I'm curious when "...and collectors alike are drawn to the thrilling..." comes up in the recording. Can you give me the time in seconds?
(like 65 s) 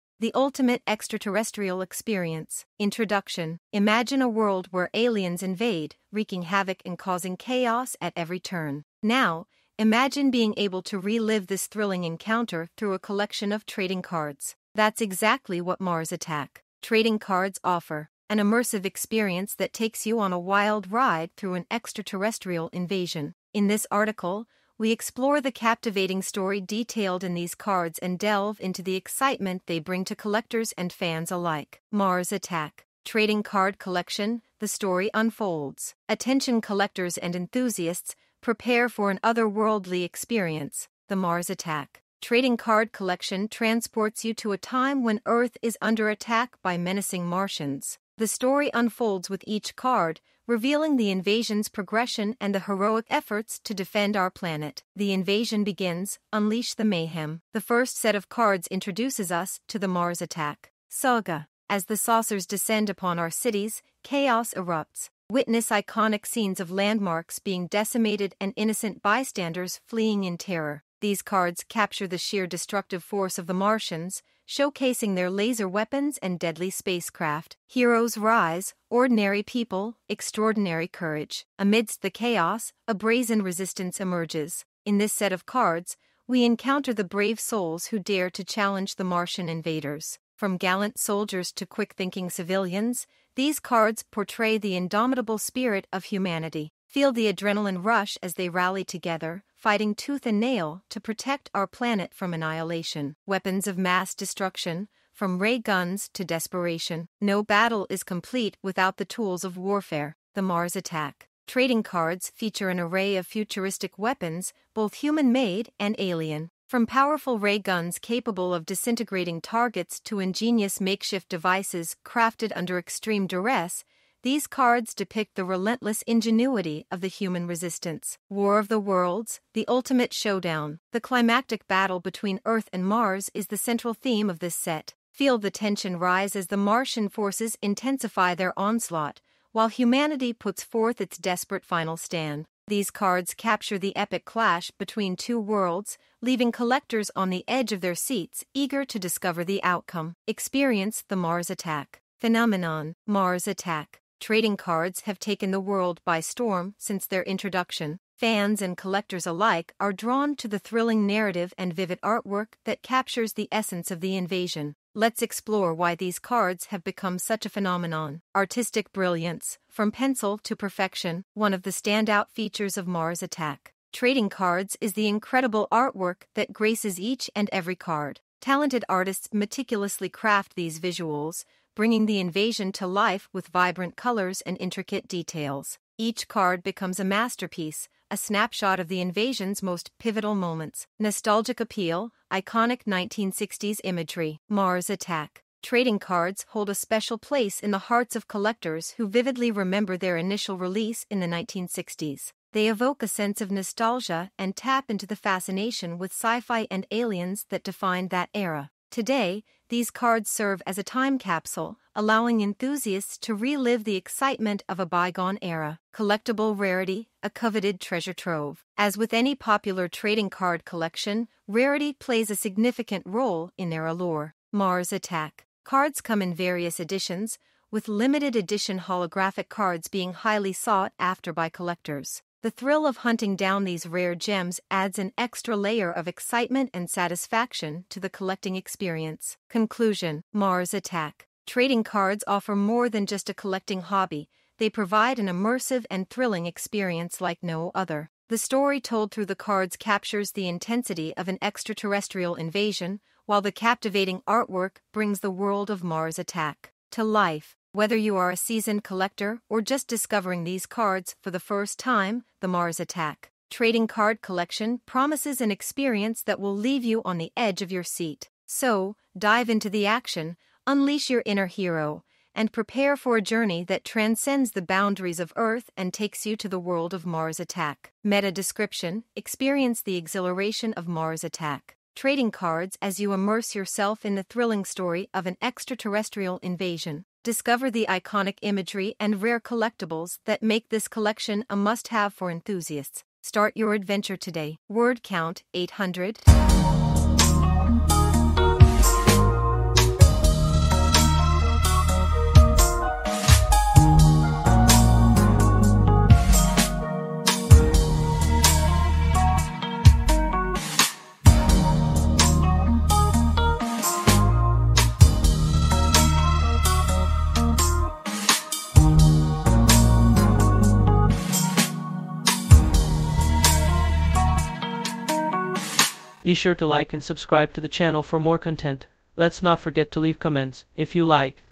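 158 s.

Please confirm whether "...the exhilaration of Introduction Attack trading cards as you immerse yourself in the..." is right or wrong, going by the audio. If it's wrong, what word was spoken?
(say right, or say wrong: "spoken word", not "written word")
wrong: "Mars", not "Introduction".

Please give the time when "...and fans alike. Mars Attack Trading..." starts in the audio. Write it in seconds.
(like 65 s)
30 s.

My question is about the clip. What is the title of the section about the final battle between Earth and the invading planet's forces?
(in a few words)
War of the Worlds.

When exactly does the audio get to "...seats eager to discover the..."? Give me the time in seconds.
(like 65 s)
147 s.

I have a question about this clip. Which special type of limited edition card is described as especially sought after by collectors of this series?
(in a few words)
holographic cards.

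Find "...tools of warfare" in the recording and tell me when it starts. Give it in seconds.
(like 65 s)
109 s.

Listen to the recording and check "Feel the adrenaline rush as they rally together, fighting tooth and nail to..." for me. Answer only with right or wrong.
right.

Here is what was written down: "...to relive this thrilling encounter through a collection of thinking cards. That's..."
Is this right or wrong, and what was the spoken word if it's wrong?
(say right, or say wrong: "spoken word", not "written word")
wrong: "trading", not "thinking".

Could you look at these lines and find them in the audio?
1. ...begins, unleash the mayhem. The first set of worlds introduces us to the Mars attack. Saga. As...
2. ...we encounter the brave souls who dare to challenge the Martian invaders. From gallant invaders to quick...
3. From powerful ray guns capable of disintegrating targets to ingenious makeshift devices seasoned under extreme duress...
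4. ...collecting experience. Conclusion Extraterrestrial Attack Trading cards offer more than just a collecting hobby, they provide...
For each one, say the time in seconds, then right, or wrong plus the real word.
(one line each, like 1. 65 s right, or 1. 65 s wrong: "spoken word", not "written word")
1. 55 s wrong: "cards", not "worlds"
2. 86 s wrong: "soldiers", not "invaders"
3. 116 s wrong: "crafted", not "seasoned"
4. 238 s wrong: "Mars", not "Extraterrestrial".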